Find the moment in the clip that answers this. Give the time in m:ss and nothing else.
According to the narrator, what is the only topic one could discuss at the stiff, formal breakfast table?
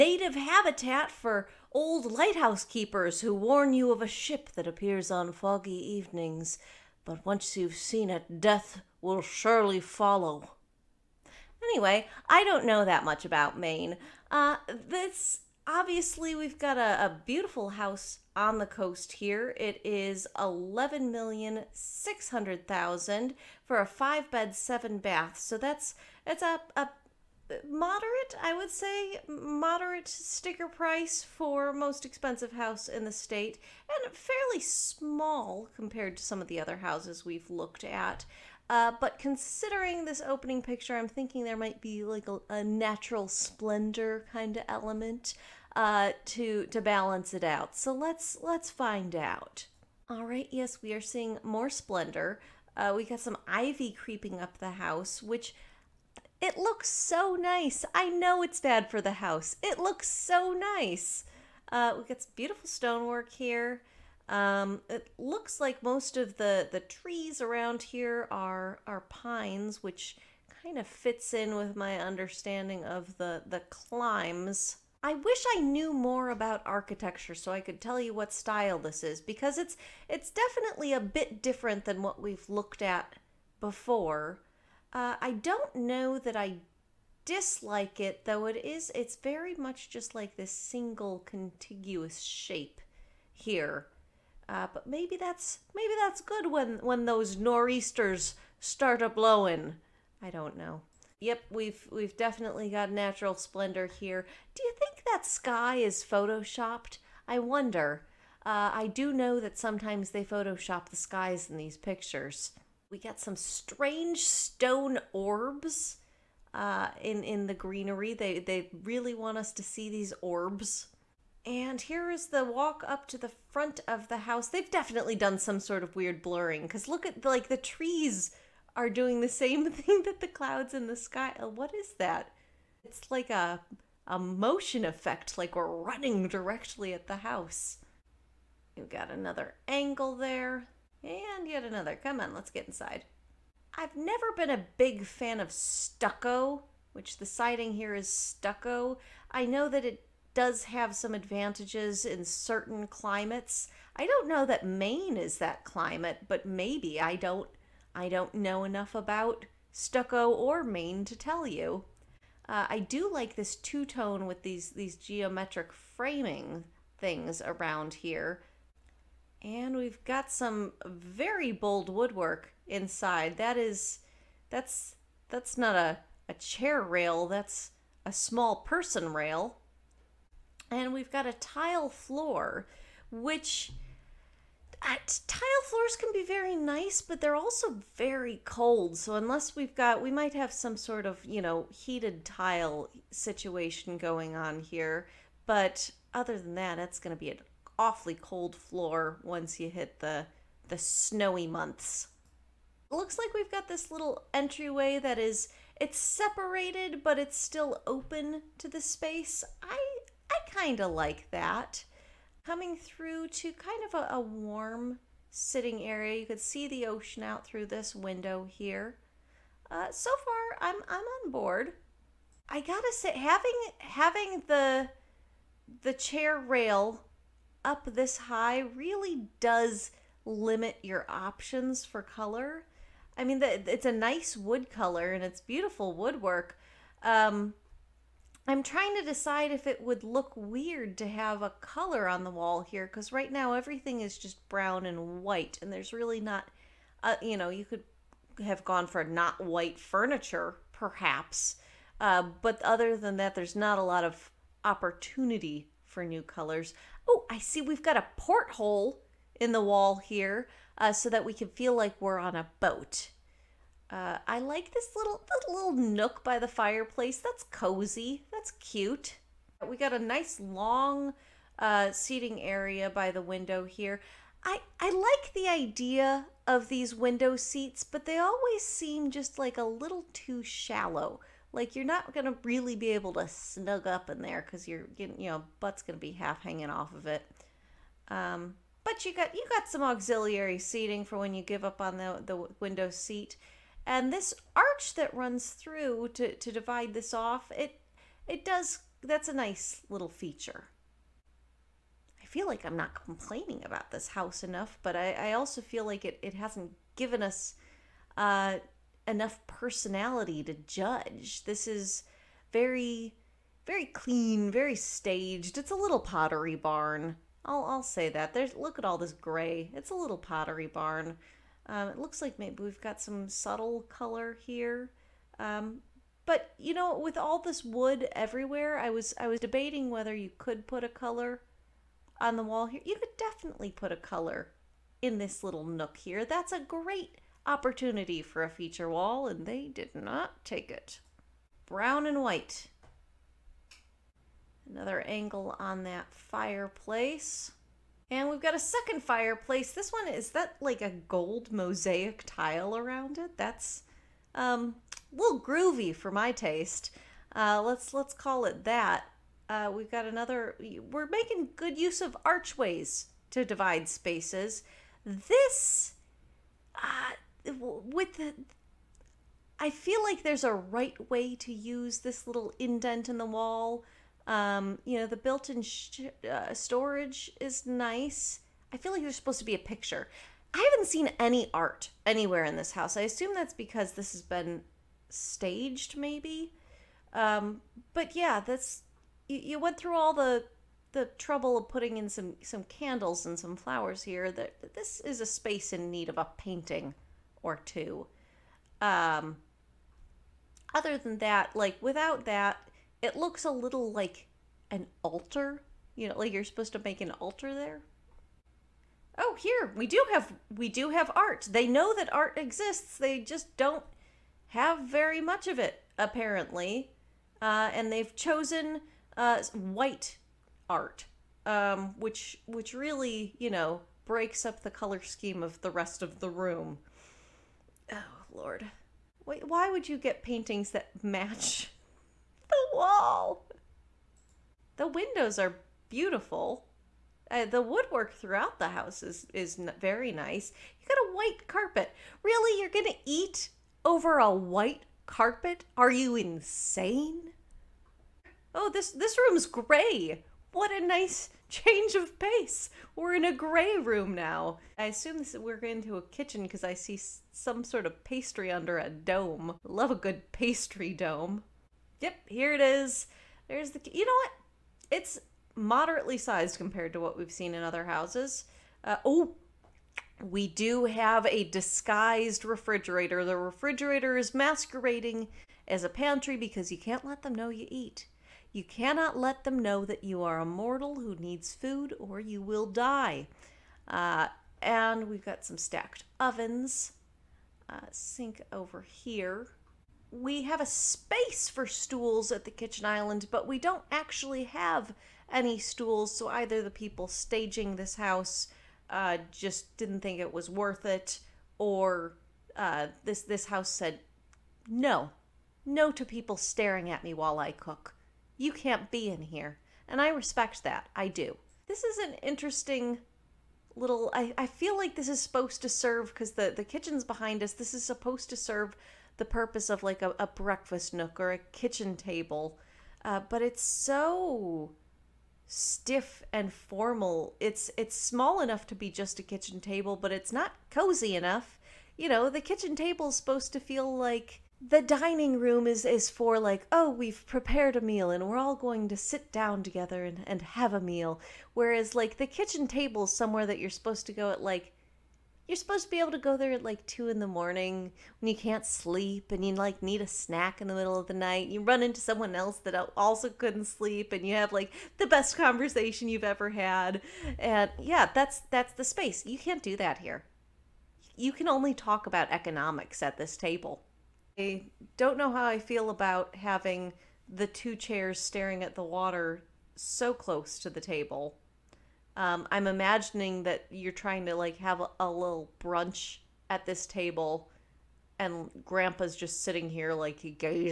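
9:22.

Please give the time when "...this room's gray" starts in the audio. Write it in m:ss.
7:28.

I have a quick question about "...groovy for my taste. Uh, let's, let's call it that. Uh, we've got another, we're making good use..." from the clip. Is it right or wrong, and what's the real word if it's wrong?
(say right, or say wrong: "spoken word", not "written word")
right.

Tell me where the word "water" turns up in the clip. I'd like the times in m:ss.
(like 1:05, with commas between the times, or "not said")
9:28.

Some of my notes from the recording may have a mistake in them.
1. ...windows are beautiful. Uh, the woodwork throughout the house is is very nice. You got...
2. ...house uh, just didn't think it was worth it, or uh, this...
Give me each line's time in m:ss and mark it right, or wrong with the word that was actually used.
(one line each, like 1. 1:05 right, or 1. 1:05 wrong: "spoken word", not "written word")
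1. 7:14 right
2. 8:17 right.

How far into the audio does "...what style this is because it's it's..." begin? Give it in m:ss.
1:18.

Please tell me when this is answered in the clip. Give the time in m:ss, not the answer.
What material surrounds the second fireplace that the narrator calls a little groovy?
5:50.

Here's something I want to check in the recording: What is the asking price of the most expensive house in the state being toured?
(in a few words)
$1,600,000.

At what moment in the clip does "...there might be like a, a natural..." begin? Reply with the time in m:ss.
0:41.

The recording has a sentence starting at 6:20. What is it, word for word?
I haven't seen any art anywhere in this house.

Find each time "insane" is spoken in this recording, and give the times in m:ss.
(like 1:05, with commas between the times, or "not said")
7:26.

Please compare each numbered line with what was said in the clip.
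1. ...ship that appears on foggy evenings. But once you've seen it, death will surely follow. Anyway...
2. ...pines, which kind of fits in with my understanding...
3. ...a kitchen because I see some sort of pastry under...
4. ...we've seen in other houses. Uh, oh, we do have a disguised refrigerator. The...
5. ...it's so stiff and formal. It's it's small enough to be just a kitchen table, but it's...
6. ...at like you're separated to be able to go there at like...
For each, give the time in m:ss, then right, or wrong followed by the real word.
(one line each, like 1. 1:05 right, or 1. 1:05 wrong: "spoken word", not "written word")
1. 0:04 right
2. 1:09 right
3. 7:35 right
4. 7:47 right
5. 8:43 right
6. 9:04 wrong: "supposed", not "separated".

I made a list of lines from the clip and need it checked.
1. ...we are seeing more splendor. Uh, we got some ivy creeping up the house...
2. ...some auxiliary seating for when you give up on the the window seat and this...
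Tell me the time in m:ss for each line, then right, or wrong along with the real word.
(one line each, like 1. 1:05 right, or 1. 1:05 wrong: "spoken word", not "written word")
1. 0:50 right
2. 4:49 right.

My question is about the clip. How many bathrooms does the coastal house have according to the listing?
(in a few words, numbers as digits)
7.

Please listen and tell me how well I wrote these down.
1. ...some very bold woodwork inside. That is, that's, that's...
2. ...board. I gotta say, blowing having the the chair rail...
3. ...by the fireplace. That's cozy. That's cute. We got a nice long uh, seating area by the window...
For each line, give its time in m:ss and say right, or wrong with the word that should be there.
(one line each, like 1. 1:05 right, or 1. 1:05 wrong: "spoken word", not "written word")
1. 2:50 right
2. 3:41 wrong: "having", not "blowing"
3. 4:26 right.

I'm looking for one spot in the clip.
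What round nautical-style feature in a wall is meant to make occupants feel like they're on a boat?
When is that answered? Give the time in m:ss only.
4:18.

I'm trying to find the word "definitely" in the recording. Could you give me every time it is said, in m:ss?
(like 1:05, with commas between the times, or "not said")
1:20, 1:42, 2:04, 5:33.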